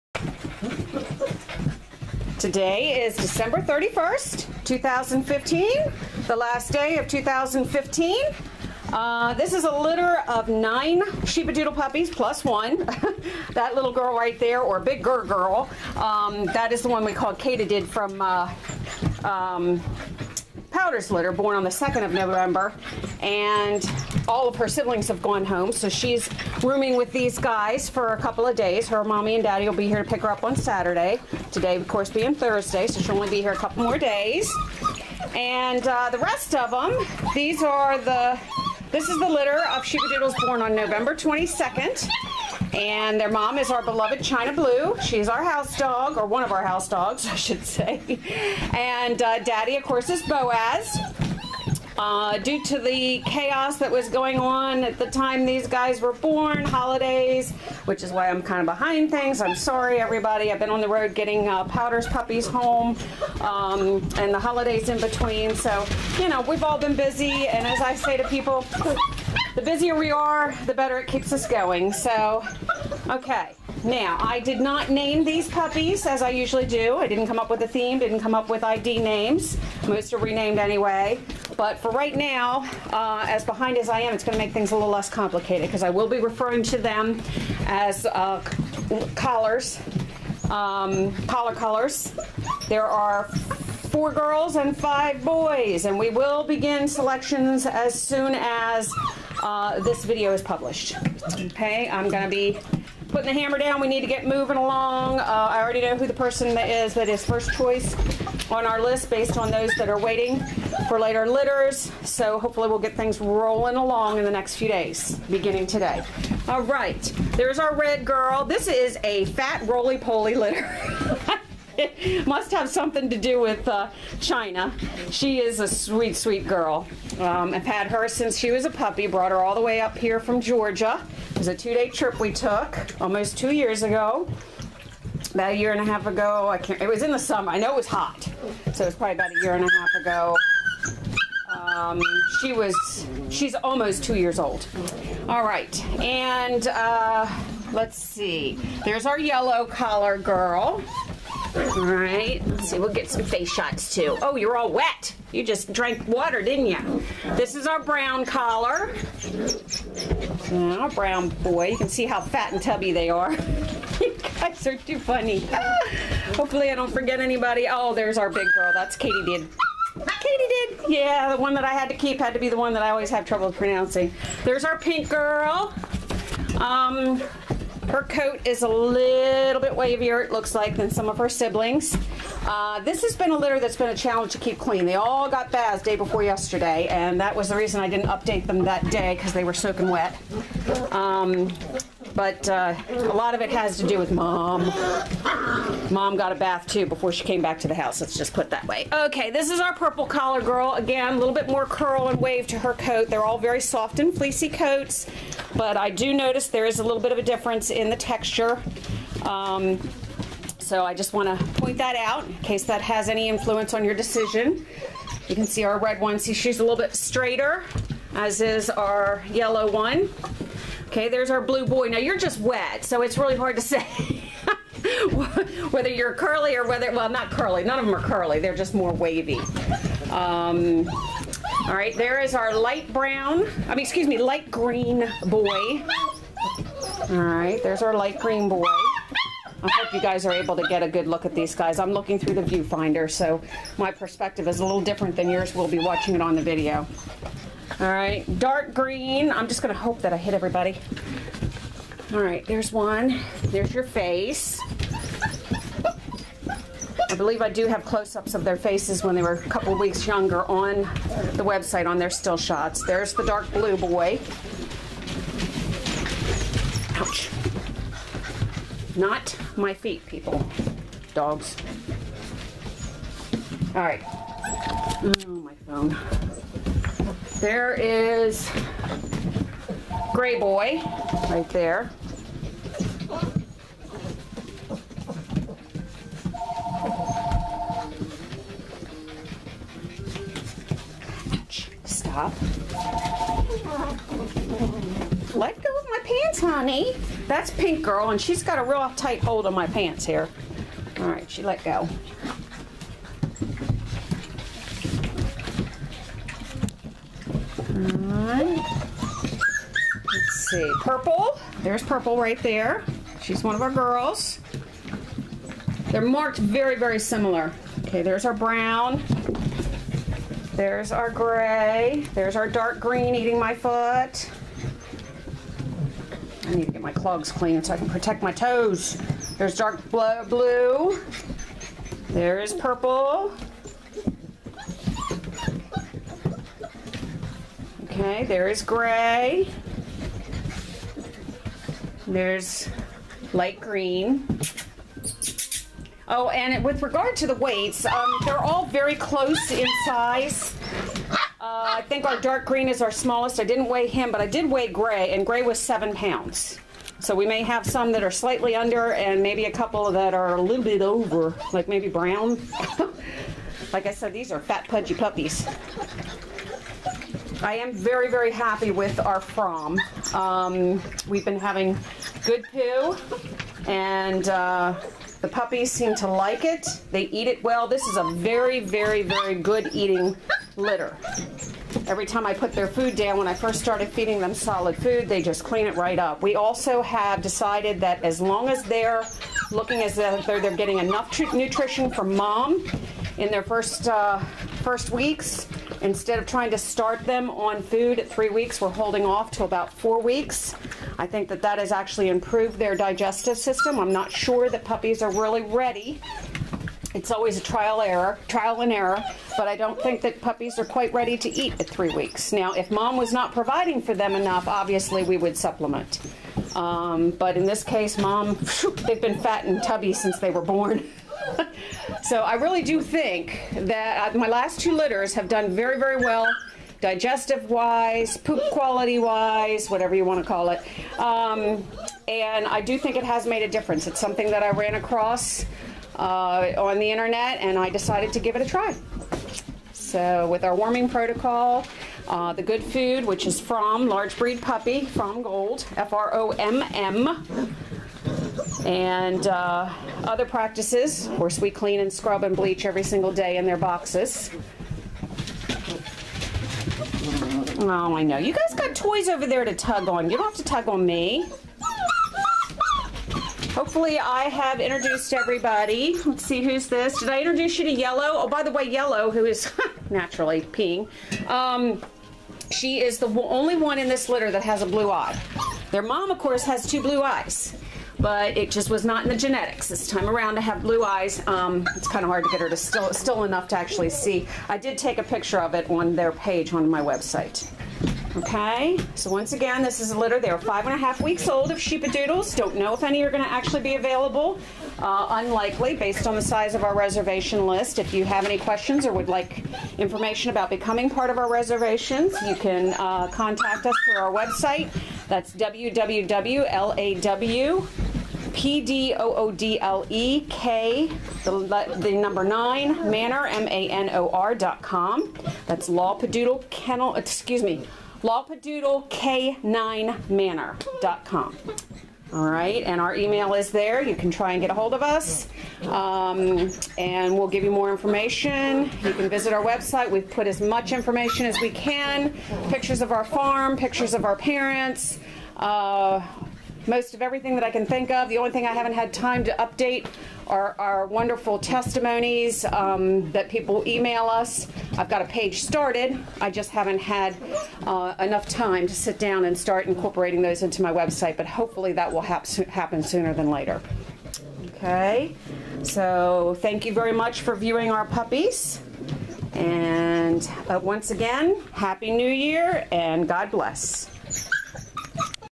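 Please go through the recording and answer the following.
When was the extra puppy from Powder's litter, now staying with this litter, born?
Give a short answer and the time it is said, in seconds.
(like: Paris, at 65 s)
November 2, at 21 s.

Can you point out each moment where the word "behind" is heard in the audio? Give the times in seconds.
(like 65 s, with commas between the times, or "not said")
58 s, 83 s.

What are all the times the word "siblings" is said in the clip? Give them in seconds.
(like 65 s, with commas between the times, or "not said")
24 s, 181 s.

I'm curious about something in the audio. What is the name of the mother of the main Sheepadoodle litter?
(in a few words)
China Blue.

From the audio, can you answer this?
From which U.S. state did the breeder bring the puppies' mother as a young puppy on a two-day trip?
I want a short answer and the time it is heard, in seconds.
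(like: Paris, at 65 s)
Georgia, at 130 s.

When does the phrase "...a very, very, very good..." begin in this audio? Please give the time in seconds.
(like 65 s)
377 s.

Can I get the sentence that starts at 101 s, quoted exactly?
Okay, I'm going to be putting the hammer down.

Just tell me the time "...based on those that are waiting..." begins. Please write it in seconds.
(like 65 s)
109 s.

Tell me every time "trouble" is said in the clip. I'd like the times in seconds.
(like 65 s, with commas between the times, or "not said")
173 s.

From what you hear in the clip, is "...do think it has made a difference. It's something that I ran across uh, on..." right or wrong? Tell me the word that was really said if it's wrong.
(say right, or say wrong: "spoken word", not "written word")
right.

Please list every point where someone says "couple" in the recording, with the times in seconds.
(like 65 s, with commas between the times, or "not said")
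28 s, 33 s, 259 s, 359 s.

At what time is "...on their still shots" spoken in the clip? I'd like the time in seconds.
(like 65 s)
261 s.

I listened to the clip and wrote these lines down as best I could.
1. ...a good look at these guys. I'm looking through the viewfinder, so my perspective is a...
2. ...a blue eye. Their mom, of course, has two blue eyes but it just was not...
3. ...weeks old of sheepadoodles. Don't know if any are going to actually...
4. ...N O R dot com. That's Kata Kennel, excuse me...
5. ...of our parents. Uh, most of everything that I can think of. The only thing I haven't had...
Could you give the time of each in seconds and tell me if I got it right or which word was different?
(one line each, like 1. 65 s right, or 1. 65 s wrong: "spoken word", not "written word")
1. 240 s right
2. 474 s right
3. 490 s right
4. 513 s wrong: "Padoodle", not "Kata"
5. 533 s right.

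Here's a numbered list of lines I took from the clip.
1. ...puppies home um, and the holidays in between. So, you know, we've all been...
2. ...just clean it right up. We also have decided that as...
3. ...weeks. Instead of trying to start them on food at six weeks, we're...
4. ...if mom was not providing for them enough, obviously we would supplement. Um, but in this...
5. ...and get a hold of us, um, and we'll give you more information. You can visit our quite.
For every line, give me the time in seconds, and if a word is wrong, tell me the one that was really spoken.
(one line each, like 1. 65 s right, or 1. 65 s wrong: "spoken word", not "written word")
1. 62 s right
2. 385 s right
3. 394 s wrong: "three", not "six"
4. 412 s right
5. 524 s wrong: "website", not "quite".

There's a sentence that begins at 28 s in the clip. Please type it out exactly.
Her mommy and daddy will be here to pick her up on Saturday.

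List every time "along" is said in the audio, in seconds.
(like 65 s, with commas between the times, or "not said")
104 s, 113 s.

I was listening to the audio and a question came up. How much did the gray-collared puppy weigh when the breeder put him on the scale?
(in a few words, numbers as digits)
7 pounds.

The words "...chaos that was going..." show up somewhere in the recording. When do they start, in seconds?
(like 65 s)
53 s.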